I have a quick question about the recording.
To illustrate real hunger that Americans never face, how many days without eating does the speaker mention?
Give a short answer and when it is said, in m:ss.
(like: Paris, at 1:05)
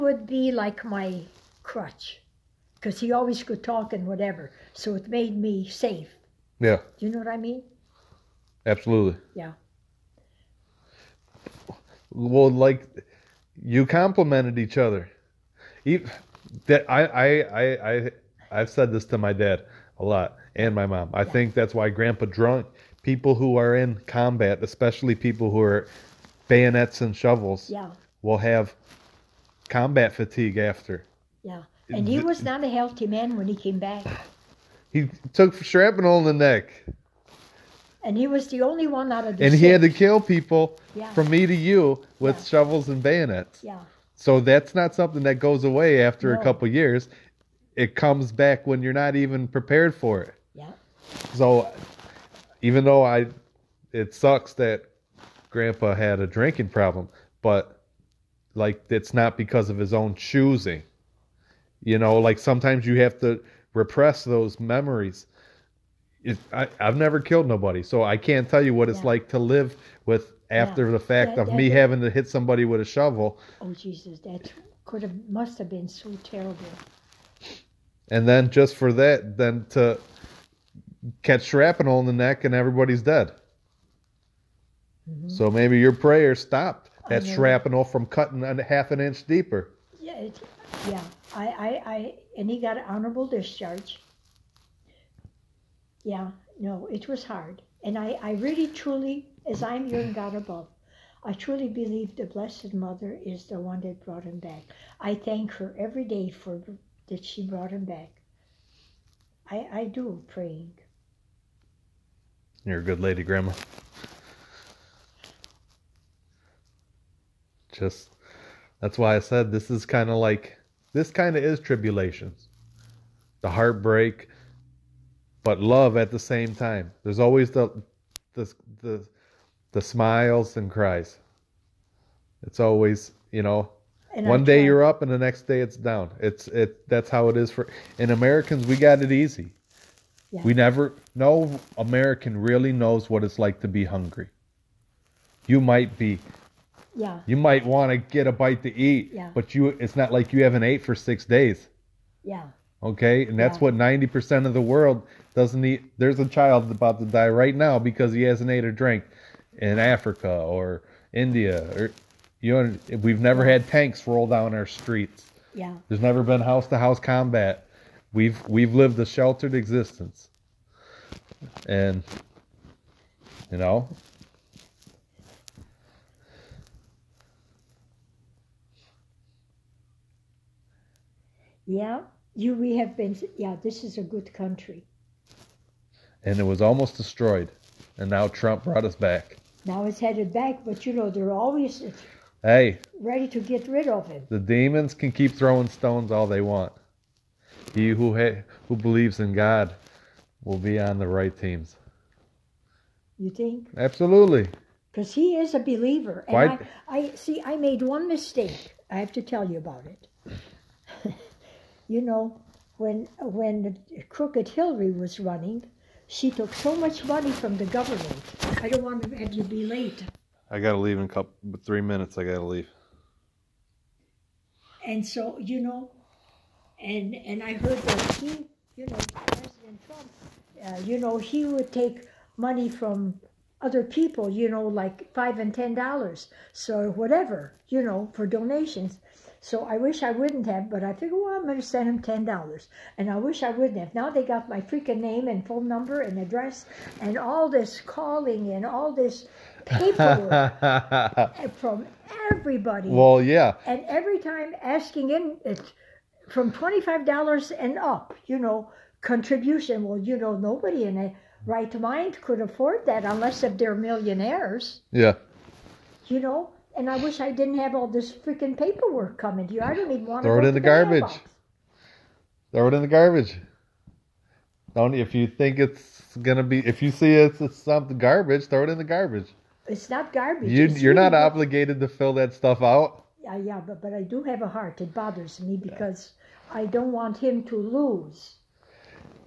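6 days, at 2:30.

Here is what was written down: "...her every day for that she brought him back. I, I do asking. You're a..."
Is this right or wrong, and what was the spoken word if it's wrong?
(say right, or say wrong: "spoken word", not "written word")
wrong: "praying", not "asking".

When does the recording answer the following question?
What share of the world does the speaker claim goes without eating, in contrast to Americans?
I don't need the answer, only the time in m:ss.
2:33.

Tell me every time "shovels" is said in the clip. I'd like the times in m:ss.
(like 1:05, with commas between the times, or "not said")
0:27, 0:42, 1:12.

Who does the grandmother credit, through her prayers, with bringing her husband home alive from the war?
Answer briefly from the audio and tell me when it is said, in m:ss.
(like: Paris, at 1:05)
The Blessed Mother, at 1:42.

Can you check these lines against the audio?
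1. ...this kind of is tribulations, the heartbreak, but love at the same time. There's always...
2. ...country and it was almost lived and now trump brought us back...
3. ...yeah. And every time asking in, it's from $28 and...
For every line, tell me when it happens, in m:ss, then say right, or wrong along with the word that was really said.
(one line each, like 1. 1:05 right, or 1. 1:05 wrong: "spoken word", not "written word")
1. 2:00 right
2. 3:04 wrong: "destroyed", not "lived"
3. 4:13 wrong: "25", not "28".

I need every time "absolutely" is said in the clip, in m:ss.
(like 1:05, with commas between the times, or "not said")
0:08, 3:23.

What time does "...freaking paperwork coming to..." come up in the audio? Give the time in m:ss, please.
4:28.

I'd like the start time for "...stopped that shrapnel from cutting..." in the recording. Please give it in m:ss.
1:26.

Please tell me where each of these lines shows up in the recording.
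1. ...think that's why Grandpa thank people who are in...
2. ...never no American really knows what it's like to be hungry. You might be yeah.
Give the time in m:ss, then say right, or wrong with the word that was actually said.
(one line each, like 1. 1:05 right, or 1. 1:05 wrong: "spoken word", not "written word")
1. 0:21 wrong: "drunk", not "thank"
2. 2:20 right.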